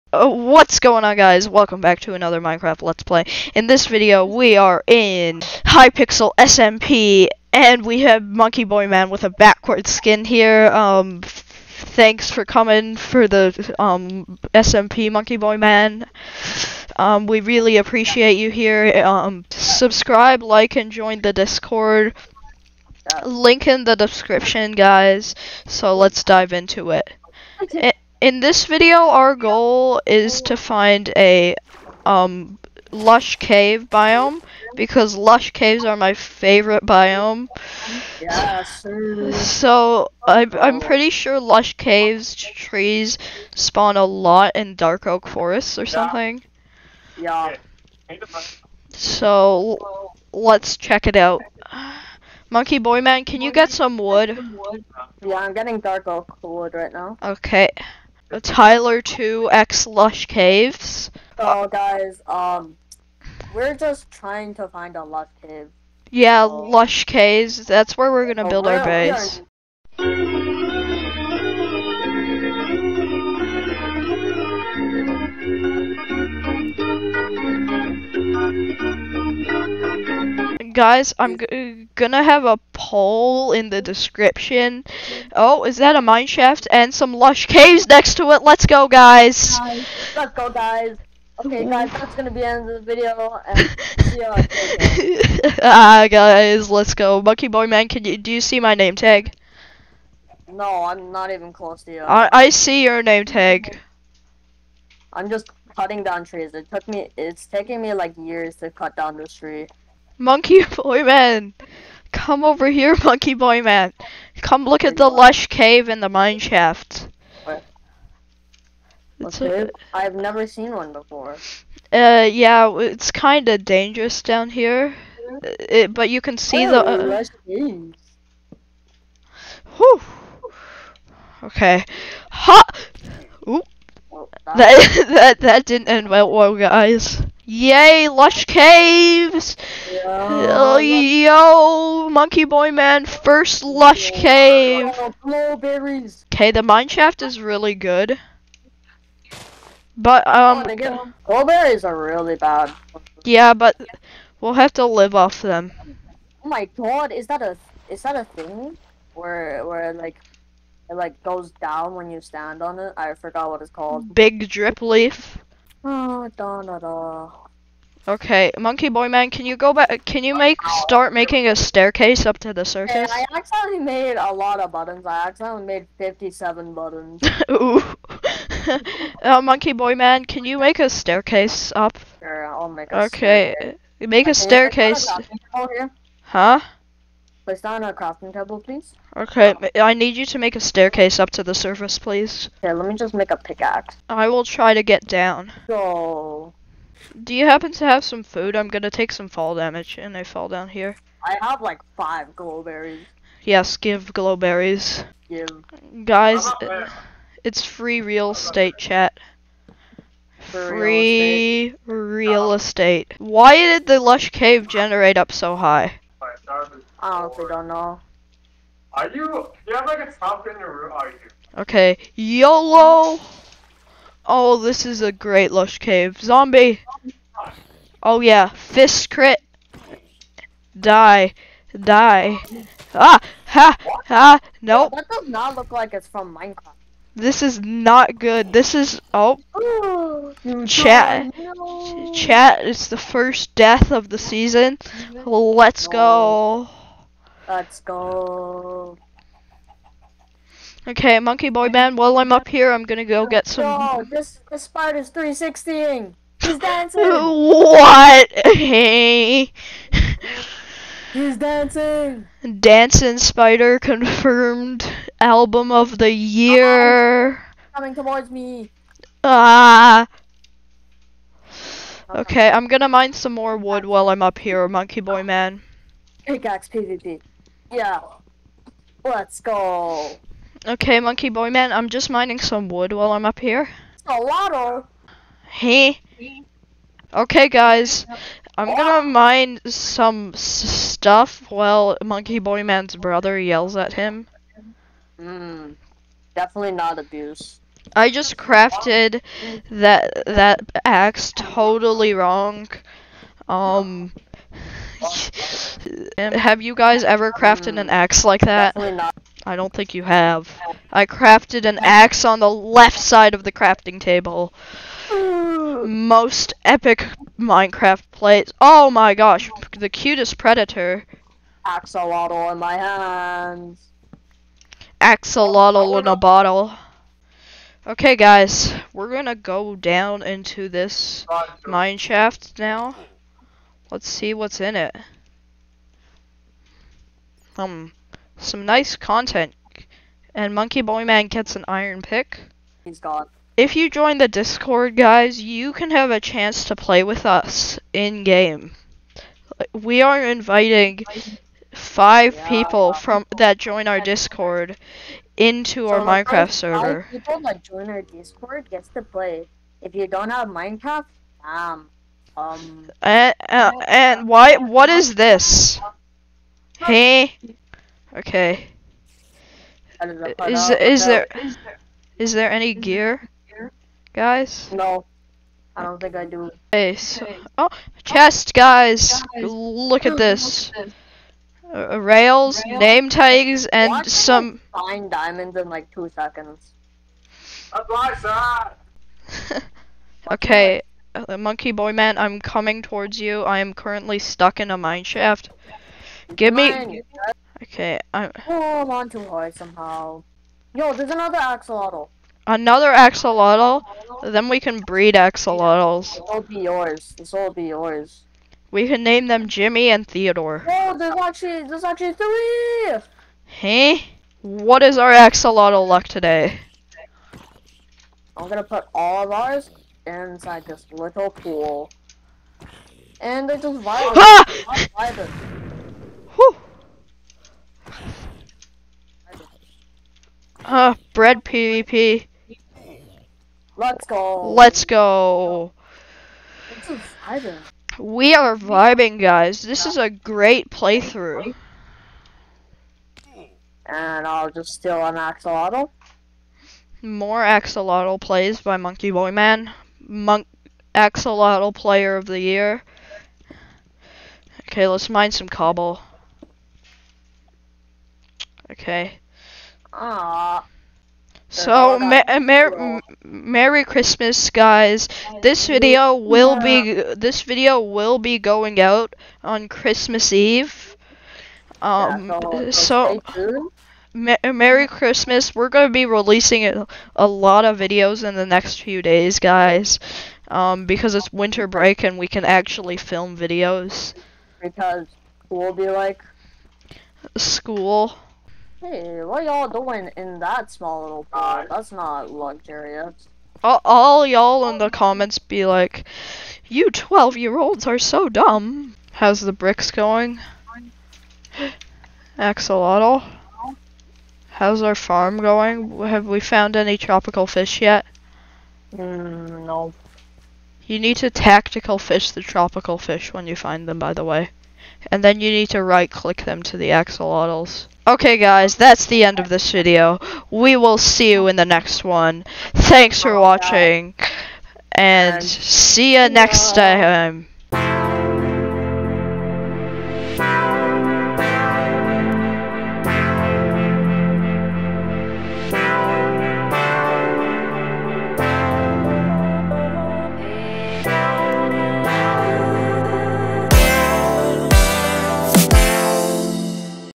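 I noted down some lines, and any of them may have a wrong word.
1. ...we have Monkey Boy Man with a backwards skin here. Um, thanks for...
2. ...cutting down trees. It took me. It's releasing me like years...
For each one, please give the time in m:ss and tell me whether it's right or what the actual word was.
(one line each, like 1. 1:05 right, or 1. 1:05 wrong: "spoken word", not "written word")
1. 0:07 right
2. 1:45 wrong: "taking", not "releasing".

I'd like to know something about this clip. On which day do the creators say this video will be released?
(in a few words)
Christmas Eve.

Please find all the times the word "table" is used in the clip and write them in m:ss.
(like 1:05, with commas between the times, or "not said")
3:08, 5:13.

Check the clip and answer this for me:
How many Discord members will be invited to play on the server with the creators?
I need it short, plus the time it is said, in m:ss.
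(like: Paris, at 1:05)
5, at 5:57.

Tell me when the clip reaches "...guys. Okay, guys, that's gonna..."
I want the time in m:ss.
1:30.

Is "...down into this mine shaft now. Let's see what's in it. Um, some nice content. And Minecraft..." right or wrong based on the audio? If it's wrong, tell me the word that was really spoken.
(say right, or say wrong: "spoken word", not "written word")
wrong: "Monkey", not "Minecraft".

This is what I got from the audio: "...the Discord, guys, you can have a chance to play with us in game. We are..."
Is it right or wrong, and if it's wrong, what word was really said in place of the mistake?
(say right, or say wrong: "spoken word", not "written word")
right.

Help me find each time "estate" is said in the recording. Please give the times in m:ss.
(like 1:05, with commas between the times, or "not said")
3:28, 3:32.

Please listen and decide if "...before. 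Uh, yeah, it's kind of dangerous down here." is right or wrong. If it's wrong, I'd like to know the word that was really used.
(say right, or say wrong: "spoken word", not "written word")
right.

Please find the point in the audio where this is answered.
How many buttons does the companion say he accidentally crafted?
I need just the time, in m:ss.
2:55.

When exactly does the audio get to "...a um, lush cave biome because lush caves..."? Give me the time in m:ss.
0:31.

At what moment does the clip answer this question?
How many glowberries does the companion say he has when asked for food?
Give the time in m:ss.
3:21.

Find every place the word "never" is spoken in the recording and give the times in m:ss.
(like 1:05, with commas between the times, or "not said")
2:00.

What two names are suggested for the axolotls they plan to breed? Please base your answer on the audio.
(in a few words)
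Jimmy and Theodore.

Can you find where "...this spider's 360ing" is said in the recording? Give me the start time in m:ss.
4:14.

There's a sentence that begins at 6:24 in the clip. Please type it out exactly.
Find diamonds in like two seconds.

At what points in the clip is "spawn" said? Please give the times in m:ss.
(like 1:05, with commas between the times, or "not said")
0:43.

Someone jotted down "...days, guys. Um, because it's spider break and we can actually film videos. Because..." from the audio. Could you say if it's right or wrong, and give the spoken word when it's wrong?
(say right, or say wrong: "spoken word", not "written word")
wrong: "winter", not "spider".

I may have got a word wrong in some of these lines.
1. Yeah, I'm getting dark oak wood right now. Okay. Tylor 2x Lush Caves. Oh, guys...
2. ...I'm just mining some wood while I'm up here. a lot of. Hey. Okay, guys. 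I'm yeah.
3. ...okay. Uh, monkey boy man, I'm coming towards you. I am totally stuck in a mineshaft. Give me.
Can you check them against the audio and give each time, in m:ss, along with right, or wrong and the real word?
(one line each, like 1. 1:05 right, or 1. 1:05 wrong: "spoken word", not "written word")
1. 0:55 right
2. 4:41 right
3. 6:30 wrong: "currently", not "totally".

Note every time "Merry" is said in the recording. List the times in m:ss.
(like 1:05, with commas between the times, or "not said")
7:43, 7:54.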